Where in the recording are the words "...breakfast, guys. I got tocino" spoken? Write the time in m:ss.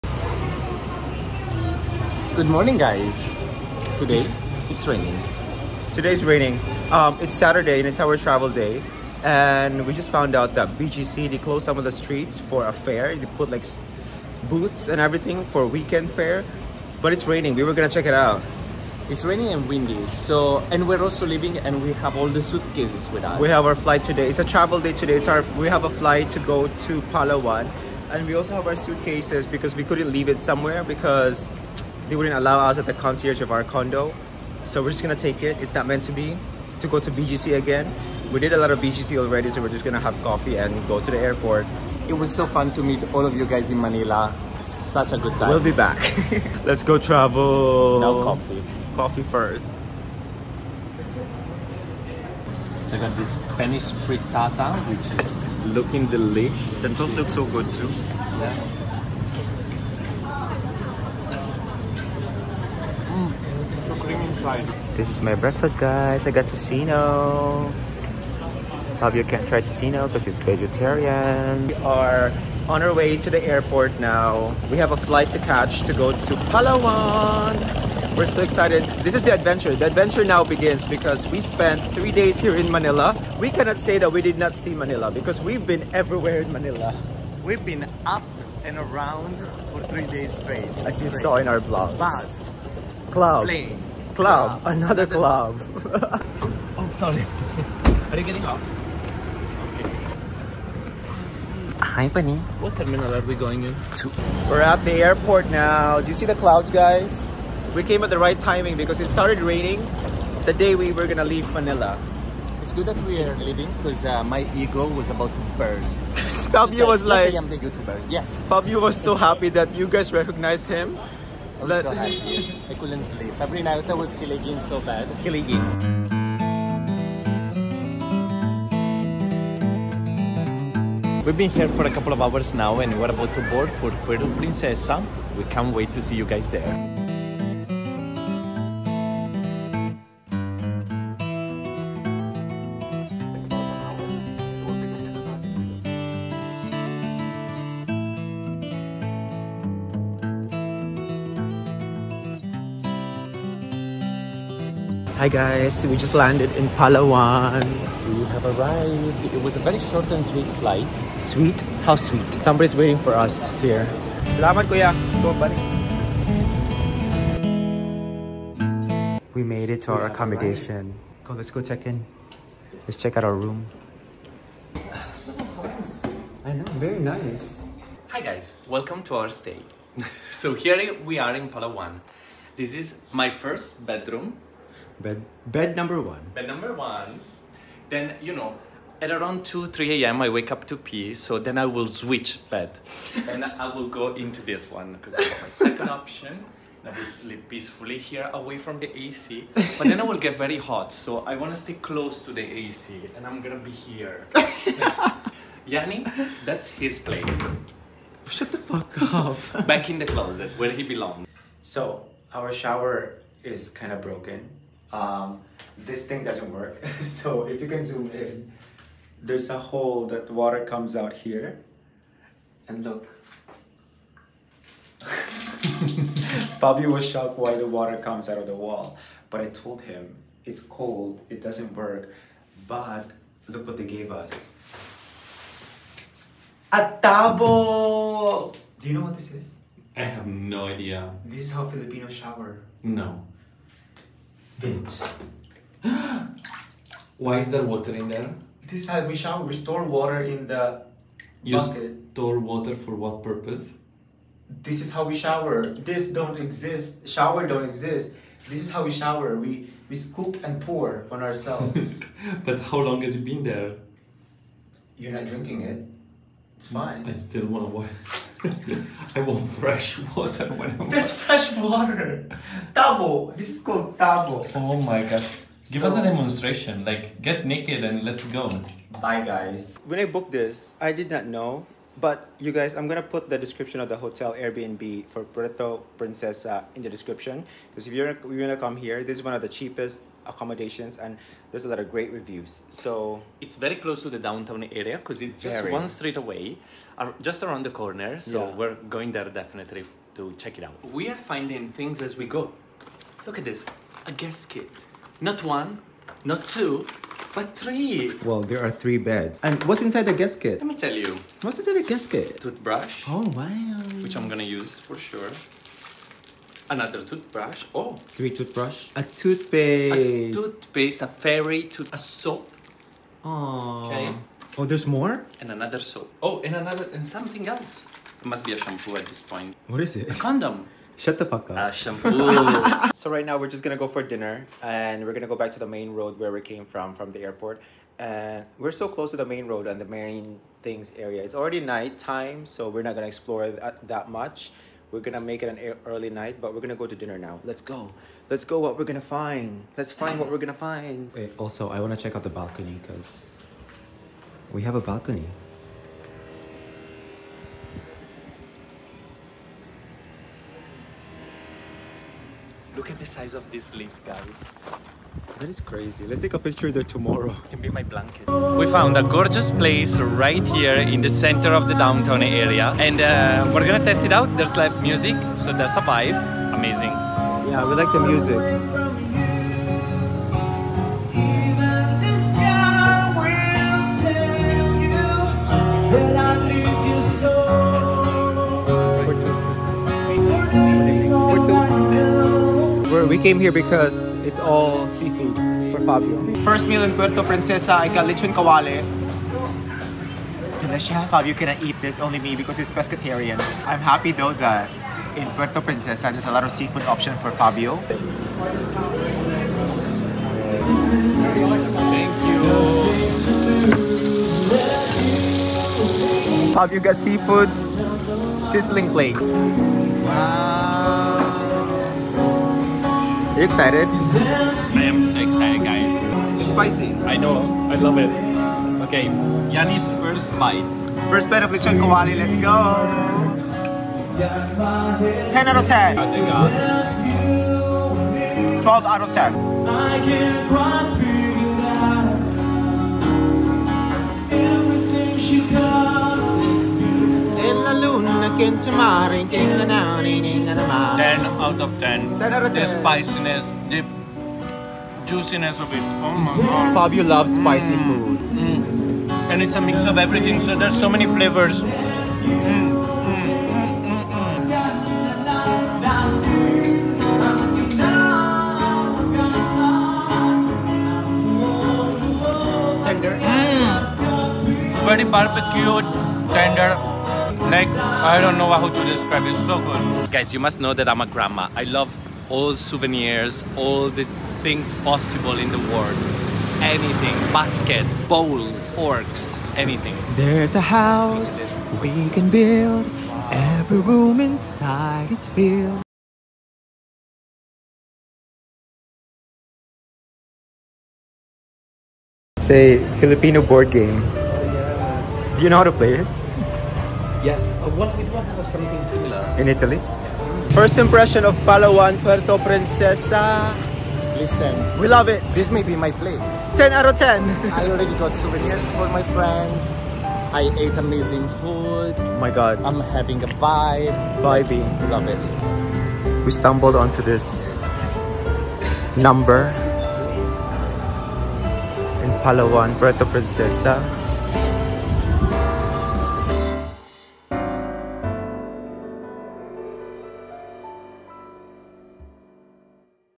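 1:05.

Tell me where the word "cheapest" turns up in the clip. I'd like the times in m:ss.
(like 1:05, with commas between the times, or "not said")
4:49.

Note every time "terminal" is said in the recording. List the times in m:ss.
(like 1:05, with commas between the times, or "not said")
1:42.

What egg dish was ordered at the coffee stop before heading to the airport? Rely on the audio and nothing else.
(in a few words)
Spanish frittata.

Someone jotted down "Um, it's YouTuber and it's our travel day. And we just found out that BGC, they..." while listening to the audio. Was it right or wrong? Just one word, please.
wrong.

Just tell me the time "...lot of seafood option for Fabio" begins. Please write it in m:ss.
6:46.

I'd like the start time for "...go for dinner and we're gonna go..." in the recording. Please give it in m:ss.
5:33.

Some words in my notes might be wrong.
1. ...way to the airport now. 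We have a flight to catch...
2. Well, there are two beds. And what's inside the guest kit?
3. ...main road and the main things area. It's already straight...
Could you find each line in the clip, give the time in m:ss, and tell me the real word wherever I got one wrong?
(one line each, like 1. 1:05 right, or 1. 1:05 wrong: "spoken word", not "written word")
1. 1:12 right
2. 5:08 wrong: "three", not "two"
3. 5:39 wrong: "night", not "straight".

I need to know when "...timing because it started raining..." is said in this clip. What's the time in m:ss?
1:48.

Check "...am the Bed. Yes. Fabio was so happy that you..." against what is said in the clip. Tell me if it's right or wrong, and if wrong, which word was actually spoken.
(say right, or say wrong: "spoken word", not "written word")
wrong: "YouTuber", not "Bed".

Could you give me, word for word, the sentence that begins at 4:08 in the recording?
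This side we shower, we store water in the you bucket.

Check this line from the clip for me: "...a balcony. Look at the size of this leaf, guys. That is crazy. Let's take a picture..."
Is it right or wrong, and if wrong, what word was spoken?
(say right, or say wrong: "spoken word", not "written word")
right.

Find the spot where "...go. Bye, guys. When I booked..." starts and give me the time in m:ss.
4:38.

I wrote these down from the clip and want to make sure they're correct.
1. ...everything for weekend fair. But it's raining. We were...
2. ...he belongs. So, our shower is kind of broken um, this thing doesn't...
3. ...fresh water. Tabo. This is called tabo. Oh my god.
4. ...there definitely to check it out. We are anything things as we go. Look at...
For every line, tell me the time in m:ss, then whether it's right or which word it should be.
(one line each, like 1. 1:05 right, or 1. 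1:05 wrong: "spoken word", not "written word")
1. 0:15 right
2. 3:30 right
3. 4:31 right
4. 4:59 wrong: "finding", not "anything".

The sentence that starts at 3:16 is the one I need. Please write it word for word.
I will sleep peacefully here away from the AC.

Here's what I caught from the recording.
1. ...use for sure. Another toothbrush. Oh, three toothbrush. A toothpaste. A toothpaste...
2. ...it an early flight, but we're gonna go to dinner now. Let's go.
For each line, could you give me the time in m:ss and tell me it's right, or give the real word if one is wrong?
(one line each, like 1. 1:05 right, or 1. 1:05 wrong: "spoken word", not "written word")
1. 5:14 right
2. 5:45 wrong: "night", not "flight".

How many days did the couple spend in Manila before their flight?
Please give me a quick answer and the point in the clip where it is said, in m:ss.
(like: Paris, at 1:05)
3, at 1:21.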